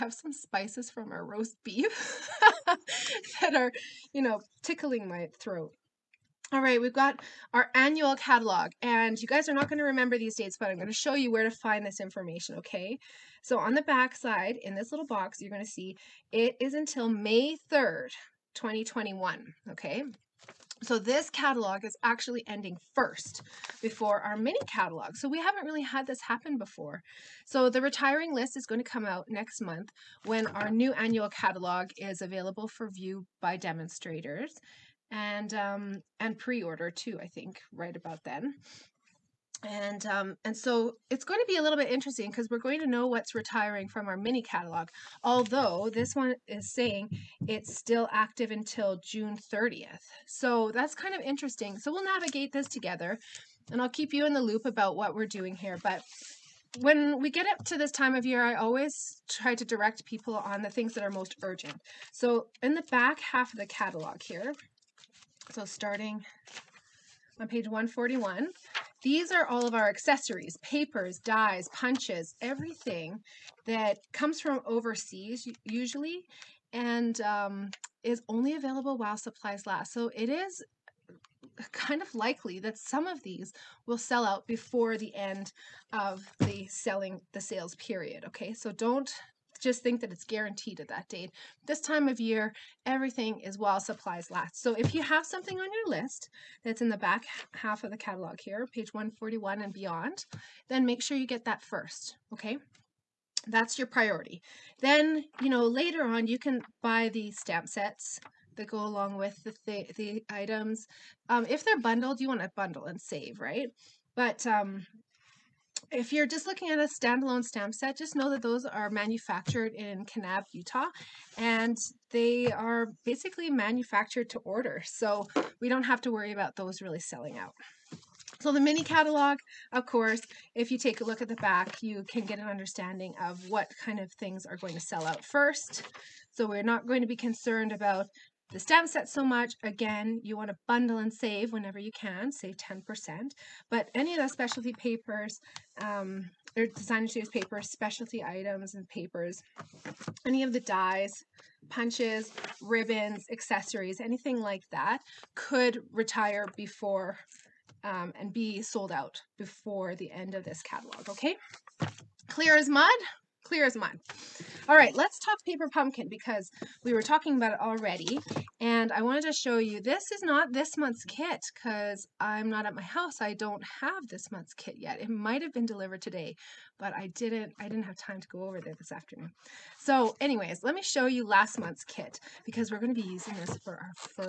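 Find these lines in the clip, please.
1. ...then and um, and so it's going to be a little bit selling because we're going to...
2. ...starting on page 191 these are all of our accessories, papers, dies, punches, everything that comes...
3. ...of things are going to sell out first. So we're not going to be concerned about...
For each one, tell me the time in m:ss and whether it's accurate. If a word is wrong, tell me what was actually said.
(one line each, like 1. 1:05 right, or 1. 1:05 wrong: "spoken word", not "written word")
1. 0:38 wrong: "interesting", not "selling"
2. 1:05 wrong: "141", not "191"
3. 2:13 right.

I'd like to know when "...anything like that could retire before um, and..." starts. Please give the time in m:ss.
2:34.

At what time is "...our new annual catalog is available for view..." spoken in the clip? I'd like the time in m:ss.
0:30.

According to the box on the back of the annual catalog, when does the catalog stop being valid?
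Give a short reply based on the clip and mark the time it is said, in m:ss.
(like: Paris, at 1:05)
May 3rd, 2021, at 0:17.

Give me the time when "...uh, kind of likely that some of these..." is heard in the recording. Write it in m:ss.
1:21.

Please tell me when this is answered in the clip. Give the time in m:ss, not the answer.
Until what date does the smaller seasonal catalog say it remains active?
0:49.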